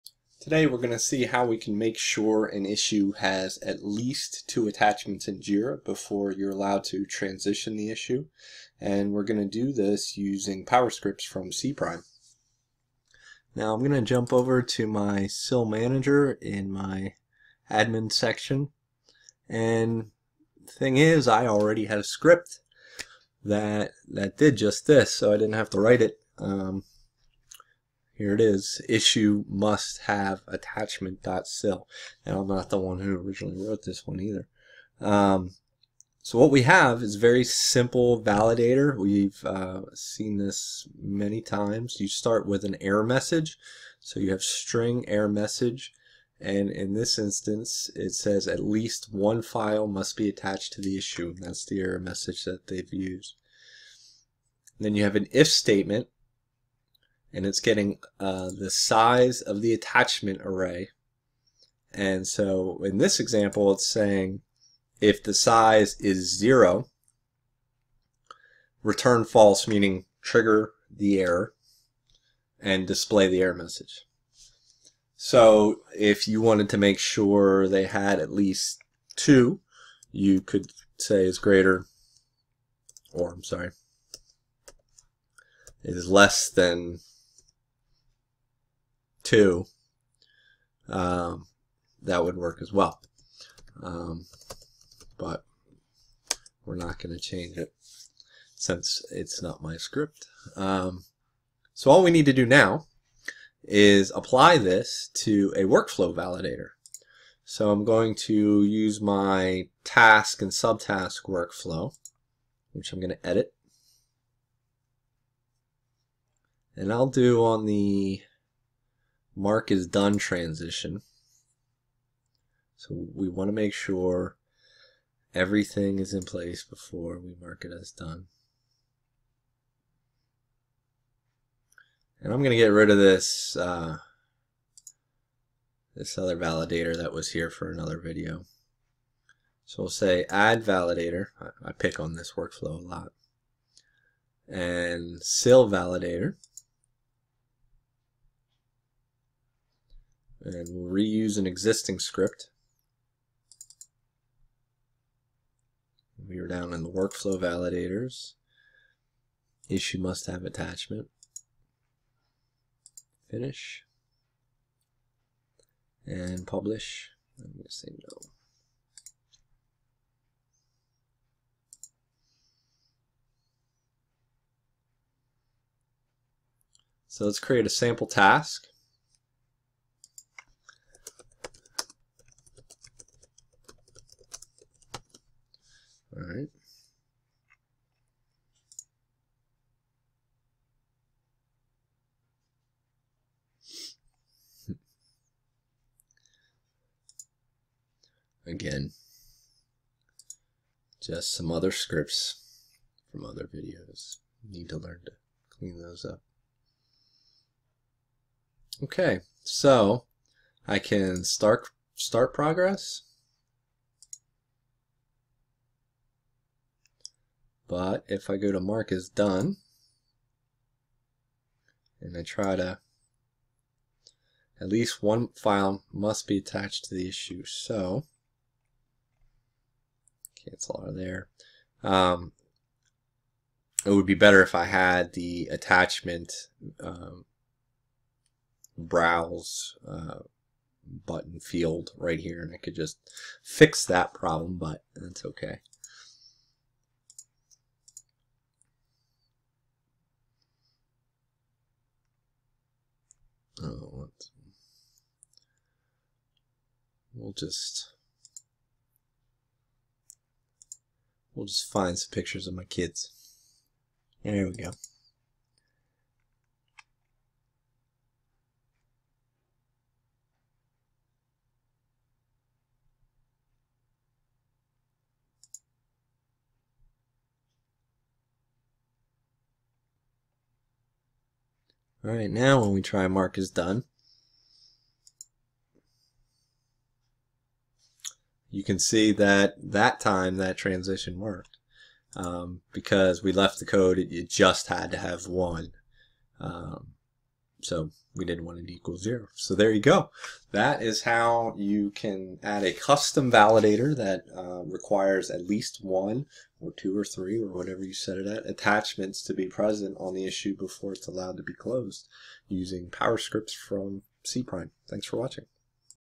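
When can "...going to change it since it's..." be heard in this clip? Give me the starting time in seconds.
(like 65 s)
96 s.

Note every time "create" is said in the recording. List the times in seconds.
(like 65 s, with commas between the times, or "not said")
177 s.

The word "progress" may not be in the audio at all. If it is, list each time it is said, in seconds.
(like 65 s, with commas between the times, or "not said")
212 s.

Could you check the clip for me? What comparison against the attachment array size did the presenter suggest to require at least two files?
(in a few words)
less than two.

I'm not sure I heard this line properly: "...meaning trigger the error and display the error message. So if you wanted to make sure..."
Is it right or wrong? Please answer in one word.
right.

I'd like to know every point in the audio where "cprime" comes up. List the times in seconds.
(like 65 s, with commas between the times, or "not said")
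11 s, 314 s.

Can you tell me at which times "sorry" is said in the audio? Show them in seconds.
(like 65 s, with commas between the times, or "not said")
83 s.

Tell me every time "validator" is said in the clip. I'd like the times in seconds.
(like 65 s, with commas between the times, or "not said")
38 s, 106 s, 136 s, 140 s, 145 s, 157 s, 303 s.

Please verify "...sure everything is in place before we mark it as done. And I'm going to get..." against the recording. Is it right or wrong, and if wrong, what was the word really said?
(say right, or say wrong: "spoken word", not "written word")
right.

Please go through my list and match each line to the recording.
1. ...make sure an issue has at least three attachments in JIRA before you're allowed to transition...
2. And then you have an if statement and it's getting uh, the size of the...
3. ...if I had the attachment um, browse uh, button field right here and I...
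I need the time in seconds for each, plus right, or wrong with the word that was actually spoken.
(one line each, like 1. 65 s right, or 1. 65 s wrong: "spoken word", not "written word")
1. 1 s wrong: "two", not "three"
2. 54 s right
3. 234 s right.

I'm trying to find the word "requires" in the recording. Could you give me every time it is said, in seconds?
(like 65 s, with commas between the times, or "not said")
304 s.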